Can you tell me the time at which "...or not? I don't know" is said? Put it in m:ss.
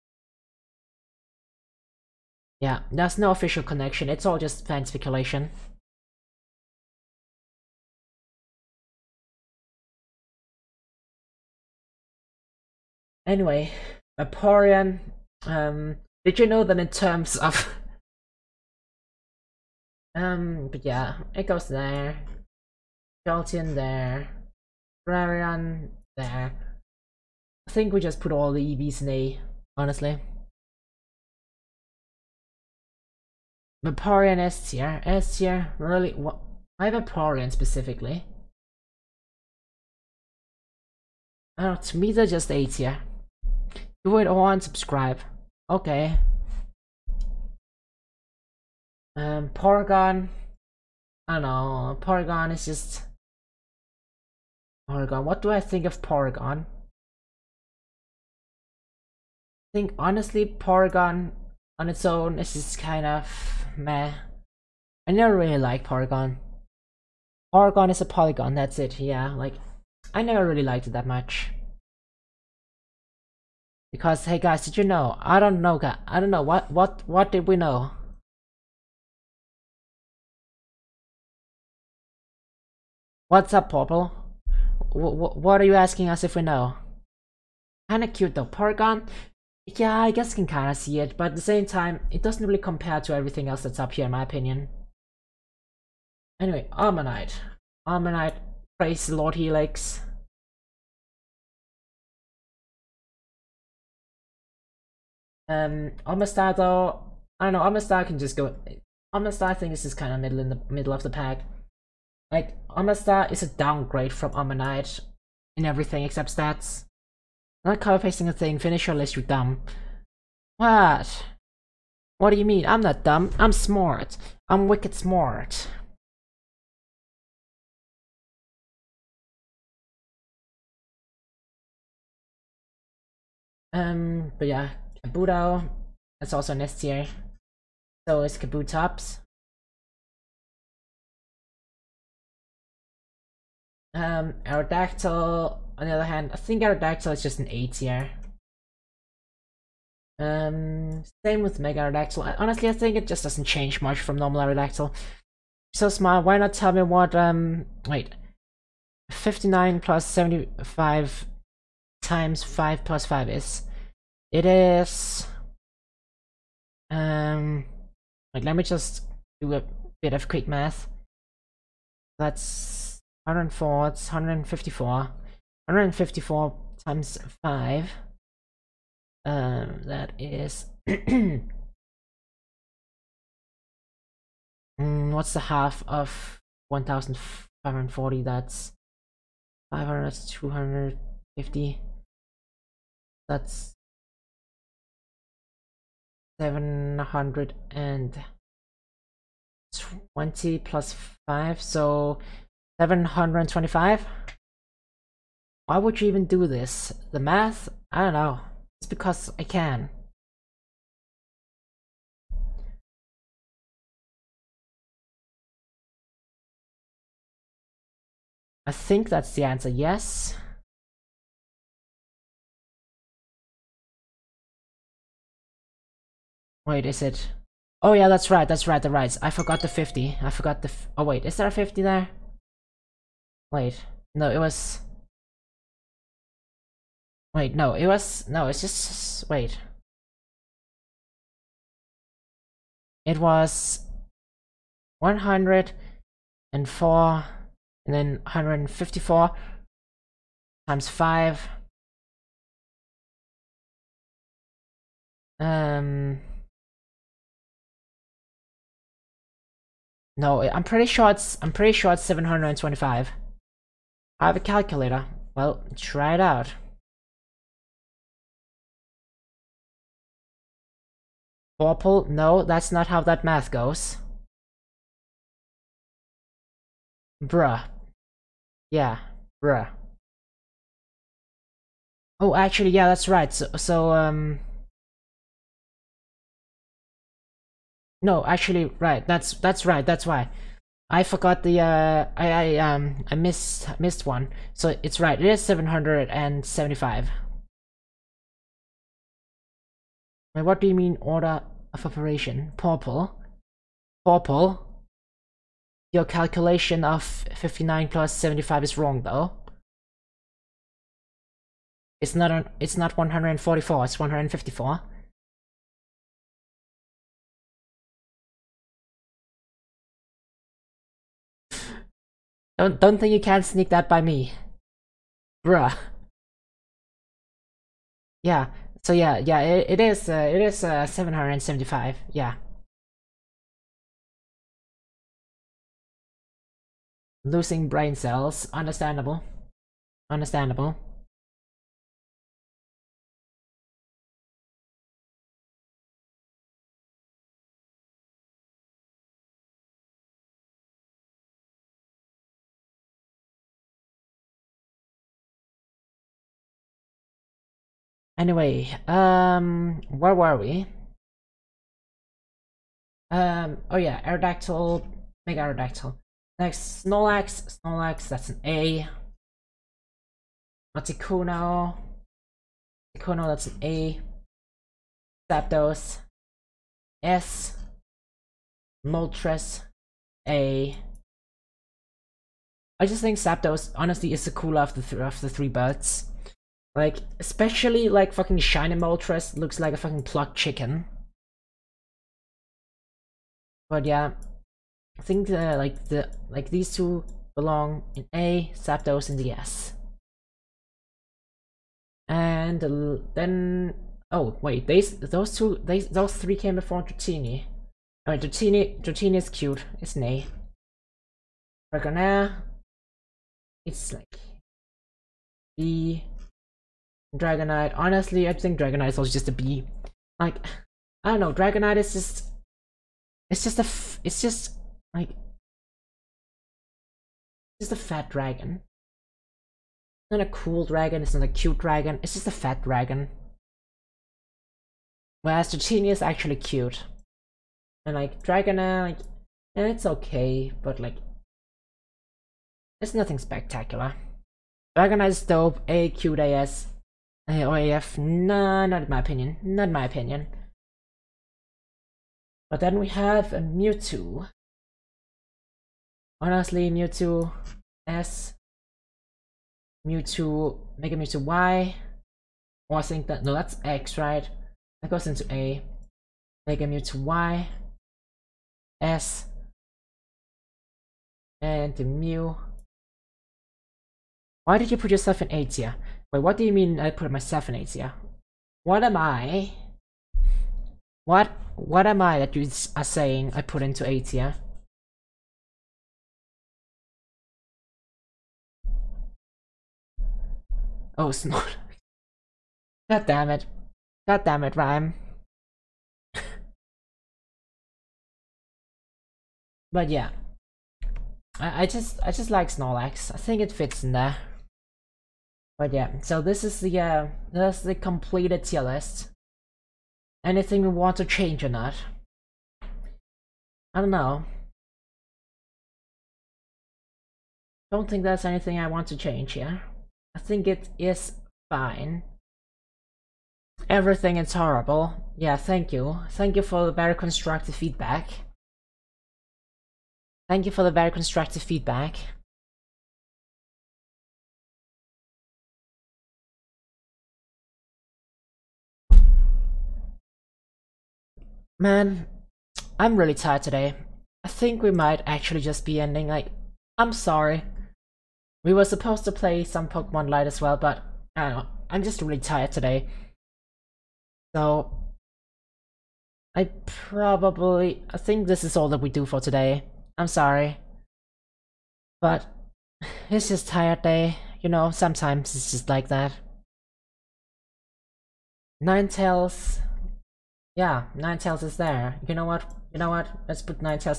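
8:31.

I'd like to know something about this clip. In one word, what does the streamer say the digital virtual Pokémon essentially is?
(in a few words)
a polygon.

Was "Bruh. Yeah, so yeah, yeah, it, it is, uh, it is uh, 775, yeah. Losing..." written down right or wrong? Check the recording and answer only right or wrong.
right.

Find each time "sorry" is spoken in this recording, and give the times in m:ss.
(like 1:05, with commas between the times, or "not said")
9:06, 9:20.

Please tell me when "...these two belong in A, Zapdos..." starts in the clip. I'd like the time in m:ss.
6:36.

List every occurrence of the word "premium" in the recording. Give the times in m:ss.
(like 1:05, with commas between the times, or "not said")
not said.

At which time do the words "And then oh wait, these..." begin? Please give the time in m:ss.
6:42.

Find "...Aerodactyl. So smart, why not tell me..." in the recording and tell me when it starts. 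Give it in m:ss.
2:34.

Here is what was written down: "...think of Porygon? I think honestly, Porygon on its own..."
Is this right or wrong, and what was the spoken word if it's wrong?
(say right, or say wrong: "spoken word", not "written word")
right.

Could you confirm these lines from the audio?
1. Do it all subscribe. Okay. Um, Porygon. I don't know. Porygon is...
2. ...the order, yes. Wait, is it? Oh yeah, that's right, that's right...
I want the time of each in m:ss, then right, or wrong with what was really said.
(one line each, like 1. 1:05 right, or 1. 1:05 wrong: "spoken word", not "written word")
1. 0:44 right
2. 3:39 wrong: "answer", not "order".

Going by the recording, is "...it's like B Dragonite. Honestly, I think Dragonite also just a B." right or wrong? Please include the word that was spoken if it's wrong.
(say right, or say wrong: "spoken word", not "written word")
right.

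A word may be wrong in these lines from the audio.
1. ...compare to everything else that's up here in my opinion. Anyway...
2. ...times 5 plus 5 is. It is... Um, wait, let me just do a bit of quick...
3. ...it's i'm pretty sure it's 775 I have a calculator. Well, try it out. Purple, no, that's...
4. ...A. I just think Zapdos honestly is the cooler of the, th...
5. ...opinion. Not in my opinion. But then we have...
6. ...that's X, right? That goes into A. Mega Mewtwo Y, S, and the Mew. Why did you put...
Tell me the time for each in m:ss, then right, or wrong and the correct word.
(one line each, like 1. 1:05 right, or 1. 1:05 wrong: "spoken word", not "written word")
1. 1:32 right
2. 2:42 right
3. 4:21 wrong: "725", not "775"
4. 6:20 right
5. 7:28 right
6. 7:43 right.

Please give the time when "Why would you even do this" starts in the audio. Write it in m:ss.
3:25.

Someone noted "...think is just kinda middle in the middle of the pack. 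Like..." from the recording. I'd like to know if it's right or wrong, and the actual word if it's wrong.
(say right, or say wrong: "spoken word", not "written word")
right.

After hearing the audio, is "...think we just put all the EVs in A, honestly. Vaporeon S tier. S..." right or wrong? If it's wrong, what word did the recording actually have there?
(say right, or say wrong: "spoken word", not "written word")
right.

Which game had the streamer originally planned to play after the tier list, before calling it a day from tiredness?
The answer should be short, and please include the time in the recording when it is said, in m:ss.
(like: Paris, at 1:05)
Pokemon Light, at 9:09.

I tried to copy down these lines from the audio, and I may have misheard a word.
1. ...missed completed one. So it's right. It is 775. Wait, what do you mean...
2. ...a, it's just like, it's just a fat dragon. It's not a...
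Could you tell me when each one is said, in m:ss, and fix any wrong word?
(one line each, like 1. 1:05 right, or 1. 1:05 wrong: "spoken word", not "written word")
1. 4:53 wrong: "missed", not "completed"
2. 7:03 right.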